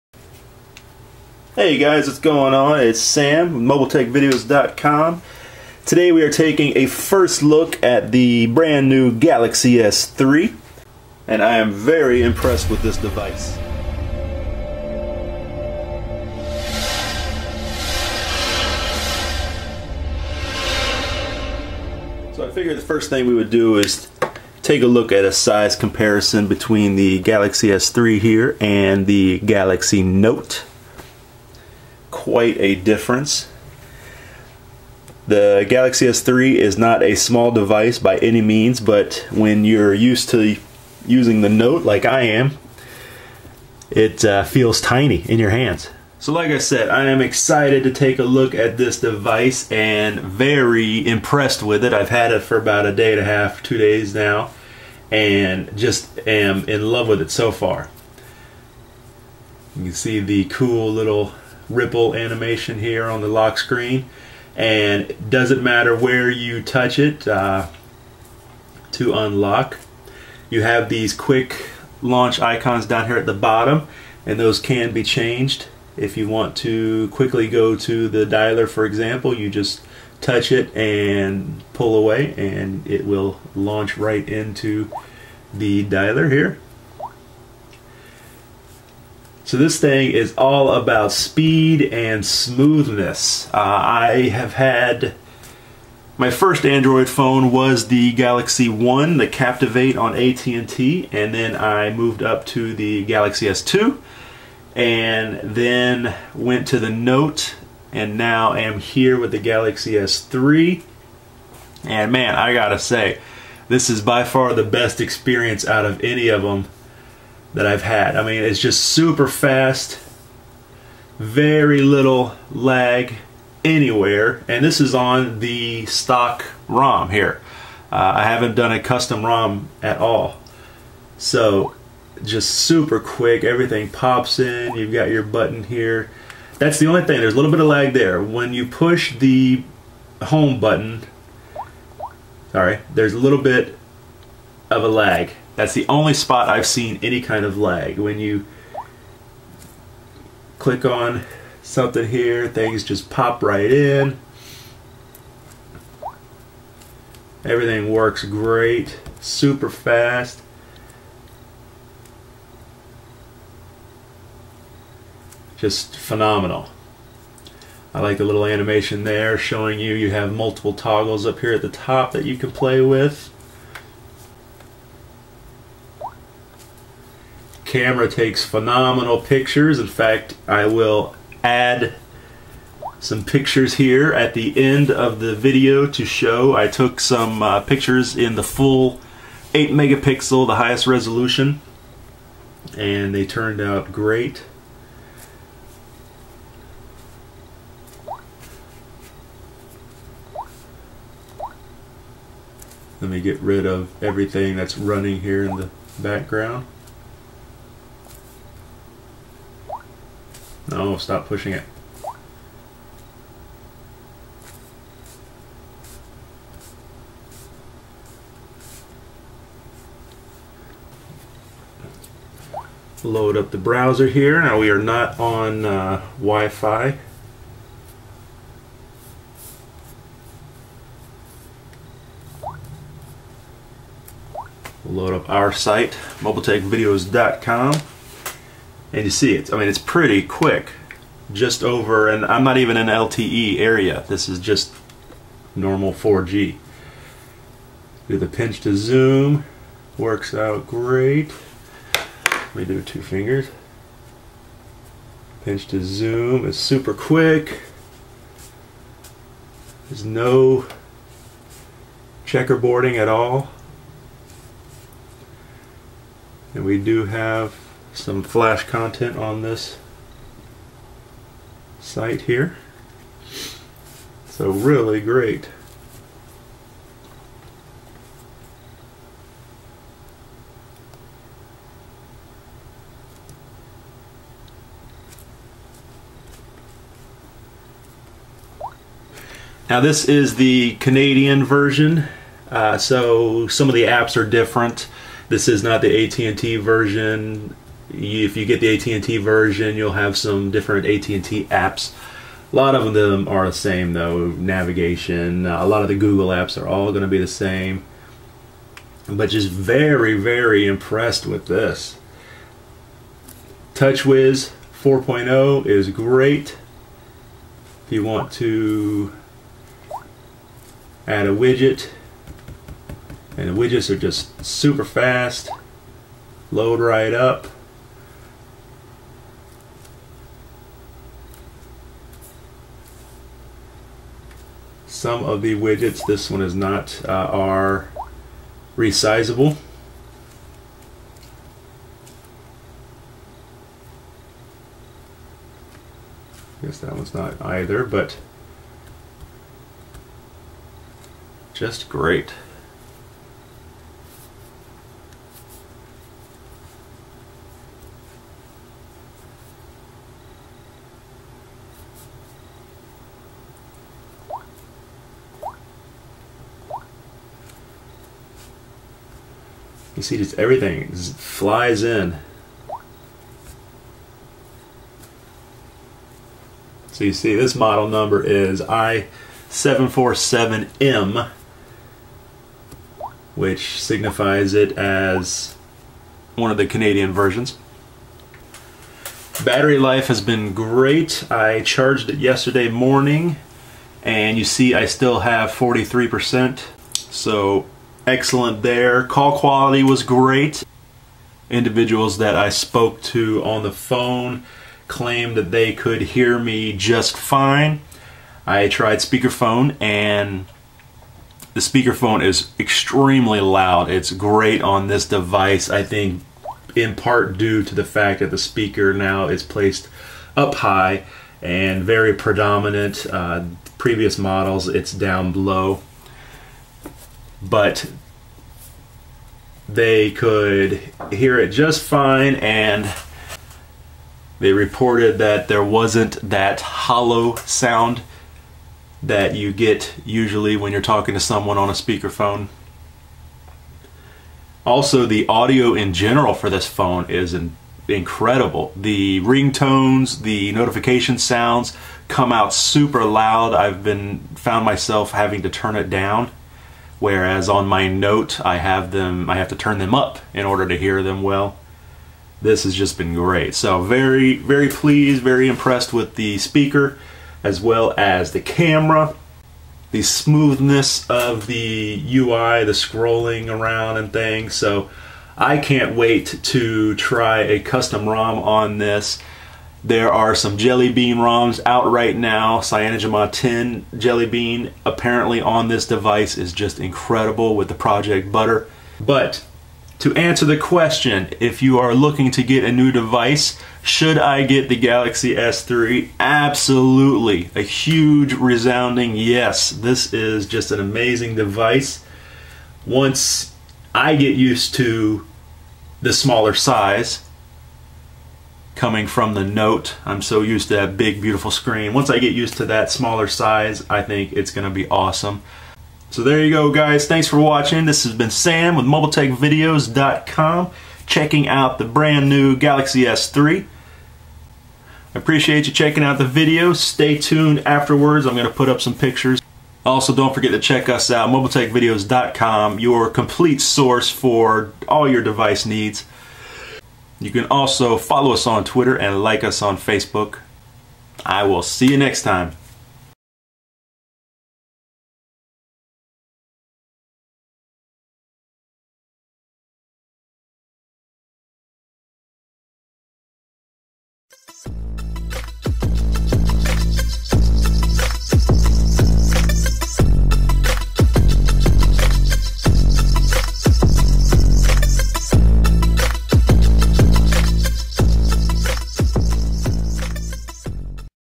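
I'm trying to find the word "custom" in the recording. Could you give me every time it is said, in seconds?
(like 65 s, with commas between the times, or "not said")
128 s, 477 s.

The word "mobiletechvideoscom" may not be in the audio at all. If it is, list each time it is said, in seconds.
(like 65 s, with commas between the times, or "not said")
3 s, 236 s, 518 s, 531 s.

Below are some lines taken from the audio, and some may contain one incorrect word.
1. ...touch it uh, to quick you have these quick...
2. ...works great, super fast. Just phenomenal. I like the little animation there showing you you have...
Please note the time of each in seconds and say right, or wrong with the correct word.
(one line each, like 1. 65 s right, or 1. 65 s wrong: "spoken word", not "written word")
1. 66 s wrong: "unlock", not "quick"
2. 157 s right.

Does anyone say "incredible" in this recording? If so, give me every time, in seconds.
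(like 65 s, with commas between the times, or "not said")
447 s, 486 s.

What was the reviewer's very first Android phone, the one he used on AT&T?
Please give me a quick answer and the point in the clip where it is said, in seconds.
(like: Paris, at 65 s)
Captivate, at 99 s.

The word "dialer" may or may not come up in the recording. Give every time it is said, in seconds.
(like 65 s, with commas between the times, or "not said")
78 s, 85 s.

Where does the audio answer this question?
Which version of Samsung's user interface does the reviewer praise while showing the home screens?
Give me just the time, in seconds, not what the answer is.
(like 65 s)
313 s.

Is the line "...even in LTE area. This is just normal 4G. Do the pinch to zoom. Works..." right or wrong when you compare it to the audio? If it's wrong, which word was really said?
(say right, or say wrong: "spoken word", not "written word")
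right.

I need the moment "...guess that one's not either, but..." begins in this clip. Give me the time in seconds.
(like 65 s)
346 s.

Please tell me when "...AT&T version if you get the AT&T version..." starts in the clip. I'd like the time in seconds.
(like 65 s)
296 s.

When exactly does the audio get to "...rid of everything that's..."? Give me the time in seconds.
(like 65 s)
203 s.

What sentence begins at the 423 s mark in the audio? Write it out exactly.
Uh, previous models, it's down low.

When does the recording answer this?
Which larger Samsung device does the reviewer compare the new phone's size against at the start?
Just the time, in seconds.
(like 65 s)
29 s.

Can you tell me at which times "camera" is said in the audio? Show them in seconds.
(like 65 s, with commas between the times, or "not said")
177 s, 468 s.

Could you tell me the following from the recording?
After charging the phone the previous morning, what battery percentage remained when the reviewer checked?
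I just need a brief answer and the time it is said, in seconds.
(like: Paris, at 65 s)
43%, at 395 s.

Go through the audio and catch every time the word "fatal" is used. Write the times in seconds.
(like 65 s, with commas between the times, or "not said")
not said.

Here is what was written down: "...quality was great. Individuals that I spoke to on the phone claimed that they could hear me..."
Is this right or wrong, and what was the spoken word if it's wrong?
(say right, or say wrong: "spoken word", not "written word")
right.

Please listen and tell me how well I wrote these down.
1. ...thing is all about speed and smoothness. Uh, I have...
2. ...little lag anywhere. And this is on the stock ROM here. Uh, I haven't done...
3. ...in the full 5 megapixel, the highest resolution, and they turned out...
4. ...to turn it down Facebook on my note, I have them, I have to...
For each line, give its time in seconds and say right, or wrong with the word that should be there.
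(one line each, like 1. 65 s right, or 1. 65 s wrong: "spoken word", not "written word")
1. 89 s right
2. 121 s right
3. 188 s wrong: "8", not "5"
4. 455 s wrong: "Whereas", not "Facebook".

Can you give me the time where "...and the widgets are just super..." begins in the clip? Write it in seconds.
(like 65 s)
323 s.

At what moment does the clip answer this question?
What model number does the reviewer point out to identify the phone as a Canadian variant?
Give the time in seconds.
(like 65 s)
378 s.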